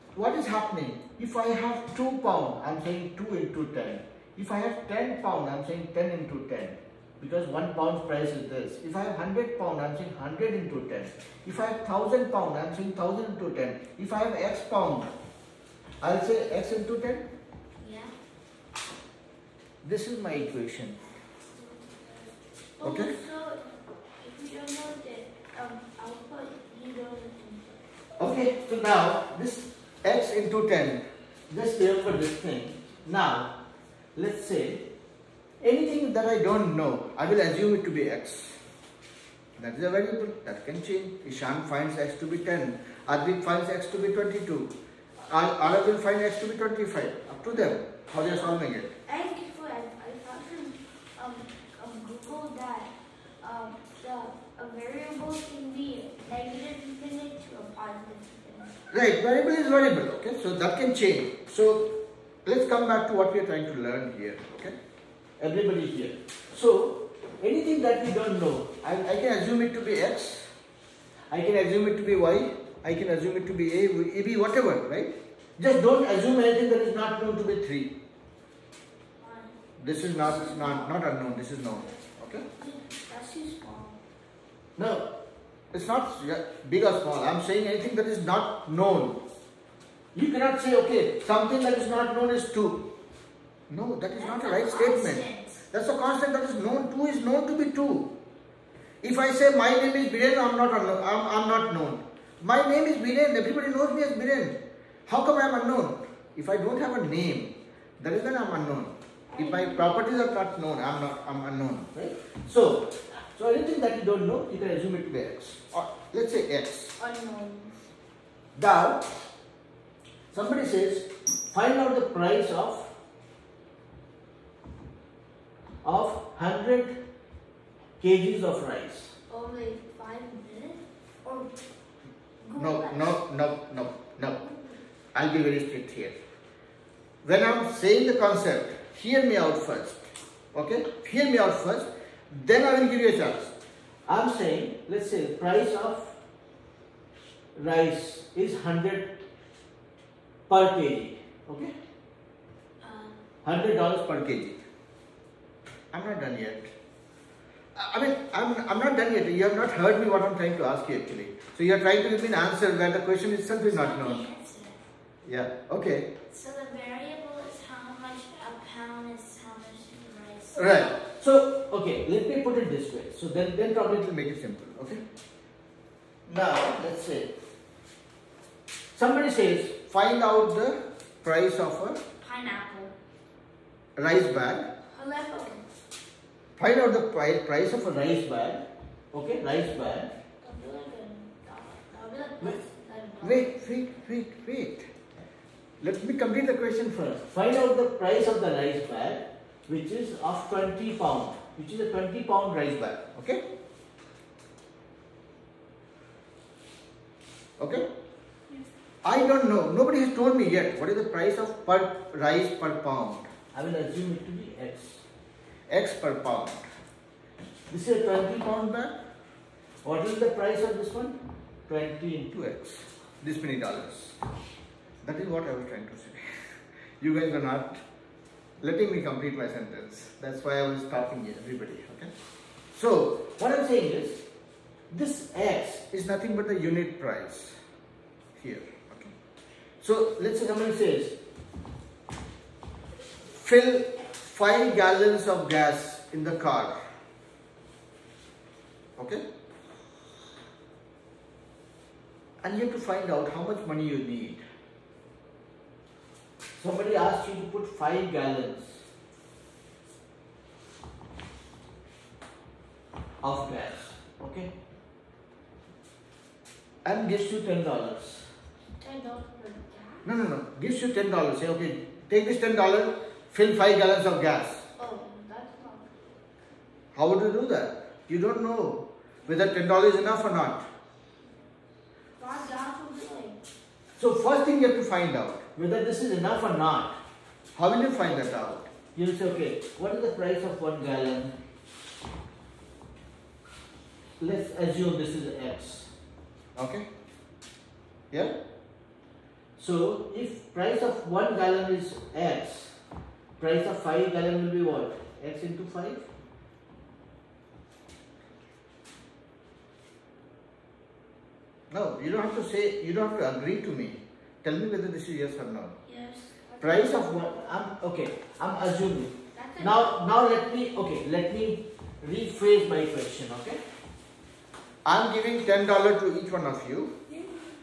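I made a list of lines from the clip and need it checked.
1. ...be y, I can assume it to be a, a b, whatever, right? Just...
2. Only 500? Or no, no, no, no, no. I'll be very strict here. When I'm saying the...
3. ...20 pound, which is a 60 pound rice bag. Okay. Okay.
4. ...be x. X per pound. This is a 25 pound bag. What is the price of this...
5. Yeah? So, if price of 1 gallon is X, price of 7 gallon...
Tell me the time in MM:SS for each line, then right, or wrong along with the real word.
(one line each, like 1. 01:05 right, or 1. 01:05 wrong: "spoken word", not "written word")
1. 01:12 right
2. 02:09 right
3. 03:20 wrong: "20", not "60"
4. 03:34 wrong: "20", not "25"
5. 04:58 wrong: "5", not "7".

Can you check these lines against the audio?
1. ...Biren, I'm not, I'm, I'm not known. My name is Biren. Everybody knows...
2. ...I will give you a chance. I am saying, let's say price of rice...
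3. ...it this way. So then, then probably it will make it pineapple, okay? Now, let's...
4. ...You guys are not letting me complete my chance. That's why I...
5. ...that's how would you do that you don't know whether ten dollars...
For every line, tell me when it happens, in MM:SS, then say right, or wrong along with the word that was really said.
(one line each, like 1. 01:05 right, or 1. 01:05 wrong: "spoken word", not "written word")
1. 01:40 right
2. 02:22 right
3. 02:52 wrong: "simple", not "pineapple"
4. 03:47 wrong: "sentence", not "chance"
5. 04:35 right.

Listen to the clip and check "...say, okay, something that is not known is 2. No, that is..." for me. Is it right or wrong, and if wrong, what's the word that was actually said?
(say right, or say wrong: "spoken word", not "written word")
right.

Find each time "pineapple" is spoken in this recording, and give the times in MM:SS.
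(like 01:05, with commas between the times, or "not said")
03:02.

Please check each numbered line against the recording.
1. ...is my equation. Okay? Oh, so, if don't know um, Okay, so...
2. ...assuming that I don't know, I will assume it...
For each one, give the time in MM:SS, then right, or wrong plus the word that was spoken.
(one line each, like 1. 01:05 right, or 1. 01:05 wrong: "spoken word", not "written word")
1. 00:20 right
2. 00:35 wrong: "anything", not "assuming".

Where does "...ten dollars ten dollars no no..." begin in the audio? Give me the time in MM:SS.
04:27.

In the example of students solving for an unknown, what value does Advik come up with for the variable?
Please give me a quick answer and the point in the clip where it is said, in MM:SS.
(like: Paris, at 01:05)
22, at 00:43.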